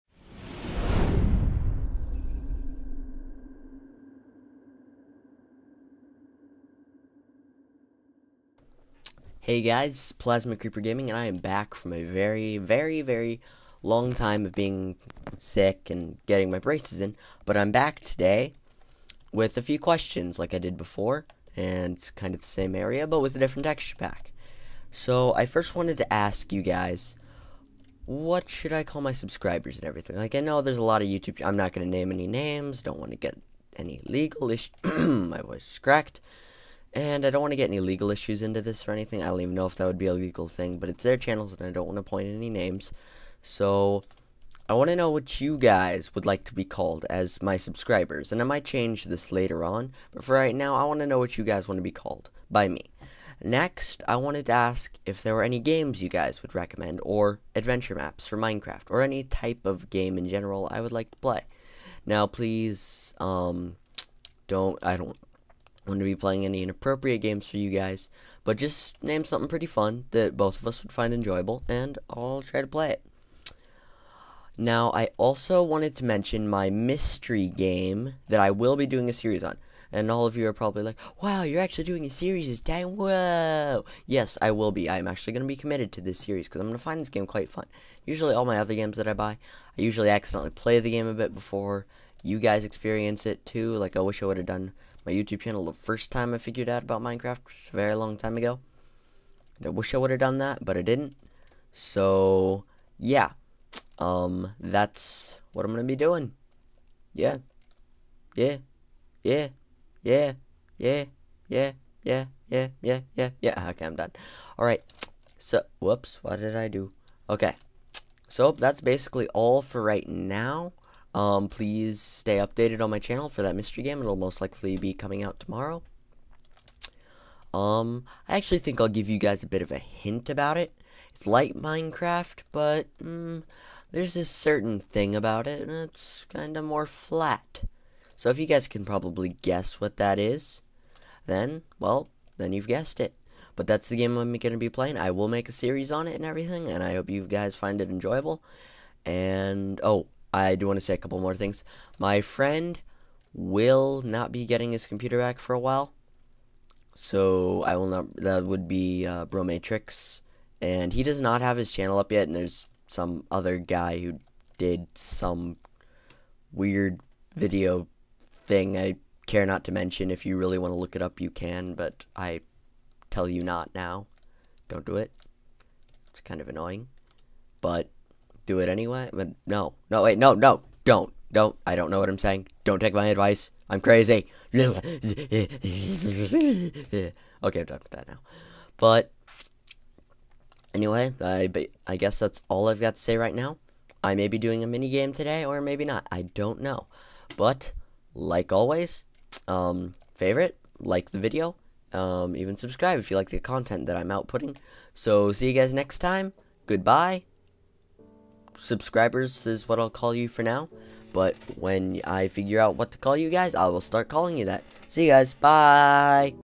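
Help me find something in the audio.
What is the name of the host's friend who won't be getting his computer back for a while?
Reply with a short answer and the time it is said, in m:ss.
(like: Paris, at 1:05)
Bromatrix, at 2:39.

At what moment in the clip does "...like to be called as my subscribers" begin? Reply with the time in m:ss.
0:46.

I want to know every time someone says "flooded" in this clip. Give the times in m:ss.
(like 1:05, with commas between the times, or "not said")
not said.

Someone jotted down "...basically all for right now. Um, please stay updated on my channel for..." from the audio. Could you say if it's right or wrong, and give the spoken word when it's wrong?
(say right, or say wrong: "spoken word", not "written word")
right.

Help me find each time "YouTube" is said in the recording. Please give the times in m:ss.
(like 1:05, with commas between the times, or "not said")
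0:31, 1:35.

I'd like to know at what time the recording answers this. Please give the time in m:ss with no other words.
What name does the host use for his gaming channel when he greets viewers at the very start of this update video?
0:10.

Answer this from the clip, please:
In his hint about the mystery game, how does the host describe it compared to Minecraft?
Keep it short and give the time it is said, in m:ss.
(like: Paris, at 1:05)
more flat, at 2:16.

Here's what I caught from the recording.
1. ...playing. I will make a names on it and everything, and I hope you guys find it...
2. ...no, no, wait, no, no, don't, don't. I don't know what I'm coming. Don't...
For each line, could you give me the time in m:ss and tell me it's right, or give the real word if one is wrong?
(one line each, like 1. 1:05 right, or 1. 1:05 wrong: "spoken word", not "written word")
1. 2:24 wrong: "series", not "names"
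2. 2:59 wrong: "saying", not "coming".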